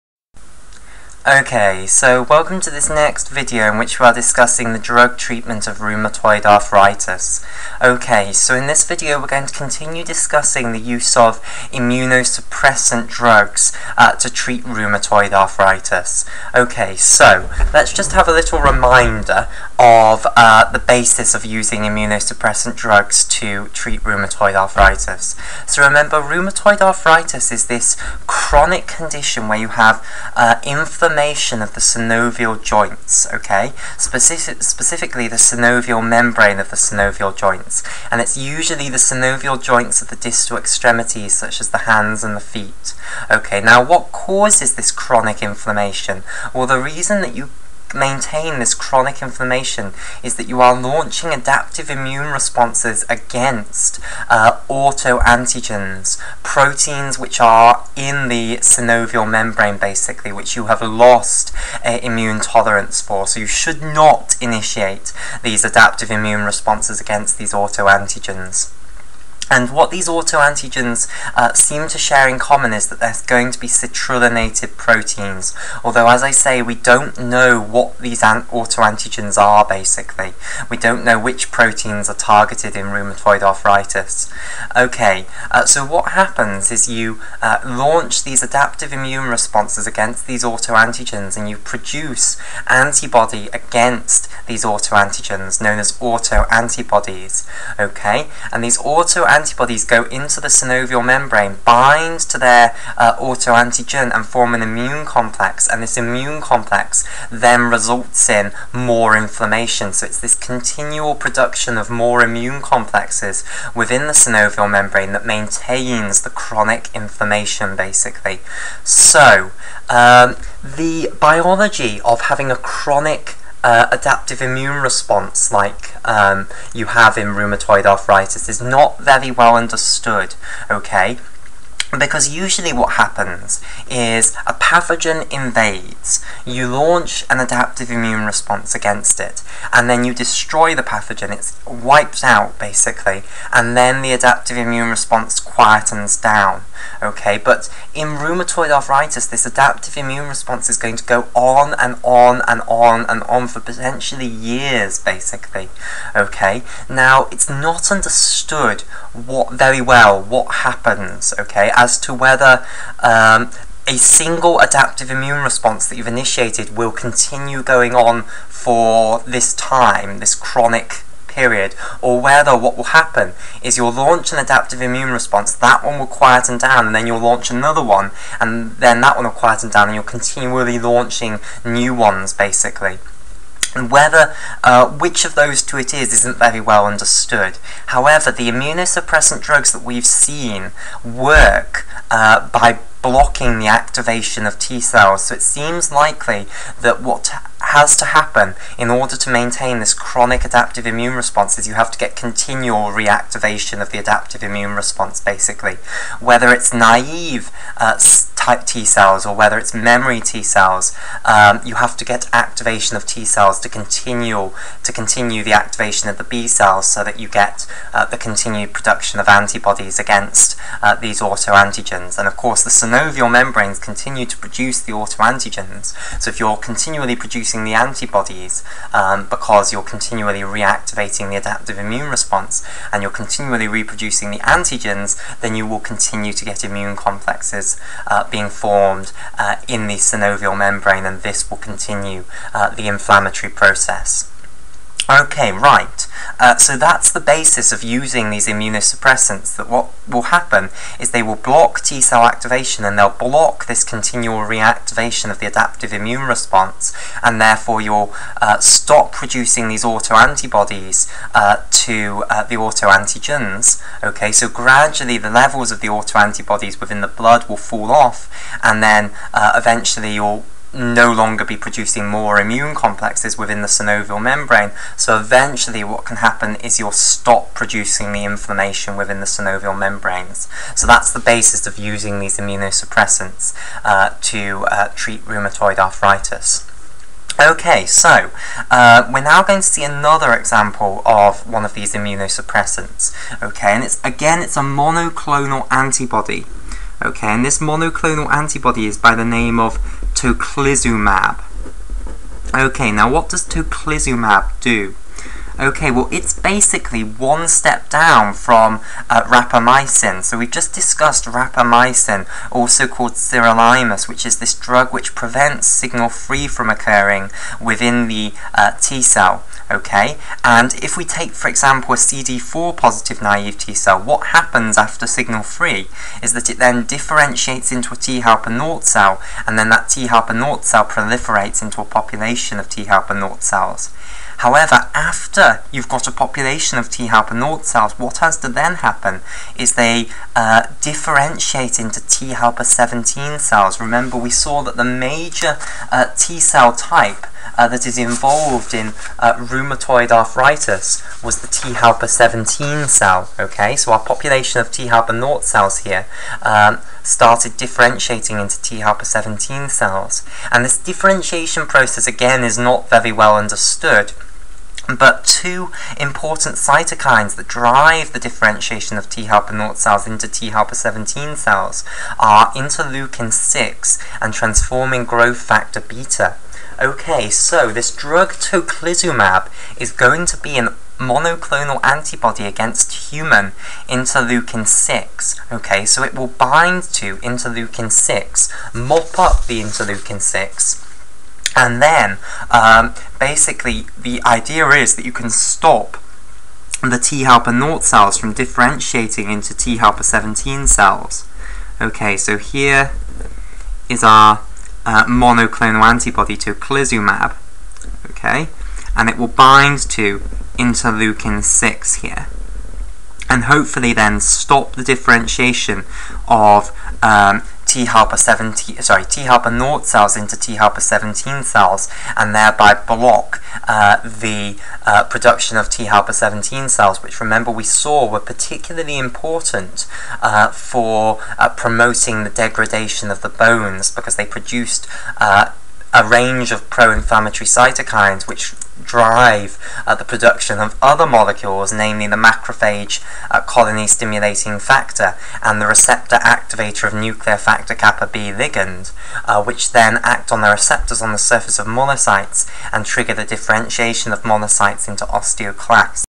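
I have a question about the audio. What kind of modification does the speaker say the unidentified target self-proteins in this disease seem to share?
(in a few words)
citrullinated.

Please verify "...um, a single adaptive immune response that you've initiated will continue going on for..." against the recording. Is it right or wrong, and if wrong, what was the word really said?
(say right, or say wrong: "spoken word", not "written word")
right.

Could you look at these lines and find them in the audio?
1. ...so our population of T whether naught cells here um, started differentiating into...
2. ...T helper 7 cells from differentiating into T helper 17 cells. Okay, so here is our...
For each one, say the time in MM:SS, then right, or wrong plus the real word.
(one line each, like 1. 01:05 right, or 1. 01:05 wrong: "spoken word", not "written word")
1. 05:53 wrong: "helper", not "whether"
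2. 06:36 wrong: "0", not "7".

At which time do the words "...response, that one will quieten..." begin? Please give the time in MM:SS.
02:55.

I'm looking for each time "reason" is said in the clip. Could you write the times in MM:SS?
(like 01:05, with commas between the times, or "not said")
00:46.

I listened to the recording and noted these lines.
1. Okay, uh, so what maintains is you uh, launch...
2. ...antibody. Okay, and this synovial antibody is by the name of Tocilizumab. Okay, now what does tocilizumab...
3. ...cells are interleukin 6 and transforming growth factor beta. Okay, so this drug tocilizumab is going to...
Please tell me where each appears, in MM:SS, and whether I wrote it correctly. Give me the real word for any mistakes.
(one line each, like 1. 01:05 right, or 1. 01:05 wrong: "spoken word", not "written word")
1. 01:24 wrong: "happens", not "maintains"
2. 04:55 wrong: "monoclonal", not "synovial"
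3. 06:11 right.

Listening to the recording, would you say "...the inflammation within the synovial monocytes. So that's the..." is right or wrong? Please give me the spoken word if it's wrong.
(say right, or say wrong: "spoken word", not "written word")
wrong: "membranes", not "monocytes".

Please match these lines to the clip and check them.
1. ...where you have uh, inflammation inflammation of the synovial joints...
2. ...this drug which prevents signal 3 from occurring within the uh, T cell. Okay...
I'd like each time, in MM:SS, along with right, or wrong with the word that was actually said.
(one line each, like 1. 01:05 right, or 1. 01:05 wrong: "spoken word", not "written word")
1. 00:29 right
2. 05:14 right.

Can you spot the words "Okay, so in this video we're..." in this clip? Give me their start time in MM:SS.
00:07.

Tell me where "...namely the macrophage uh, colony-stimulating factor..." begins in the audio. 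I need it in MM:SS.
07:21.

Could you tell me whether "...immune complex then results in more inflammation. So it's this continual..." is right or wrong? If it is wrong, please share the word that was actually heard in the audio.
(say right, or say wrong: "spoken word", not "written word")
right.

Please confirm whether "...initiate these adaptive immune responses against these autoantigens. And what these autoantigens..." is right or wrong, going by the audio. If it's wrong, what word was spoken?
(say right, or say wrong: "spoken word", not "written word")
right.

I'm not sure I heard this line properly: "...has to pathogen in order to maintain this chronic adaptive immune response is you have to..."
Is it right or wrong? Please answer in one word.
wrong.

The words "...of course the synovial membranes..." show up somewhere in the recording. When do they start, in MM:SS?
03:42.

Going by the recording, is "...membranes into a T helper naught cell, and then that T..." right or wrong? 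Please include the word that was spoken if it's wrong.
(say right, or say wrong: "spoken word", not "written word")
wrong: "differentiates", not "membranes".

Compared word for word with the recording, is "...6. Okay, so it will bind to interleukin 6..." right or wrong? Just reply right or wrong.
right.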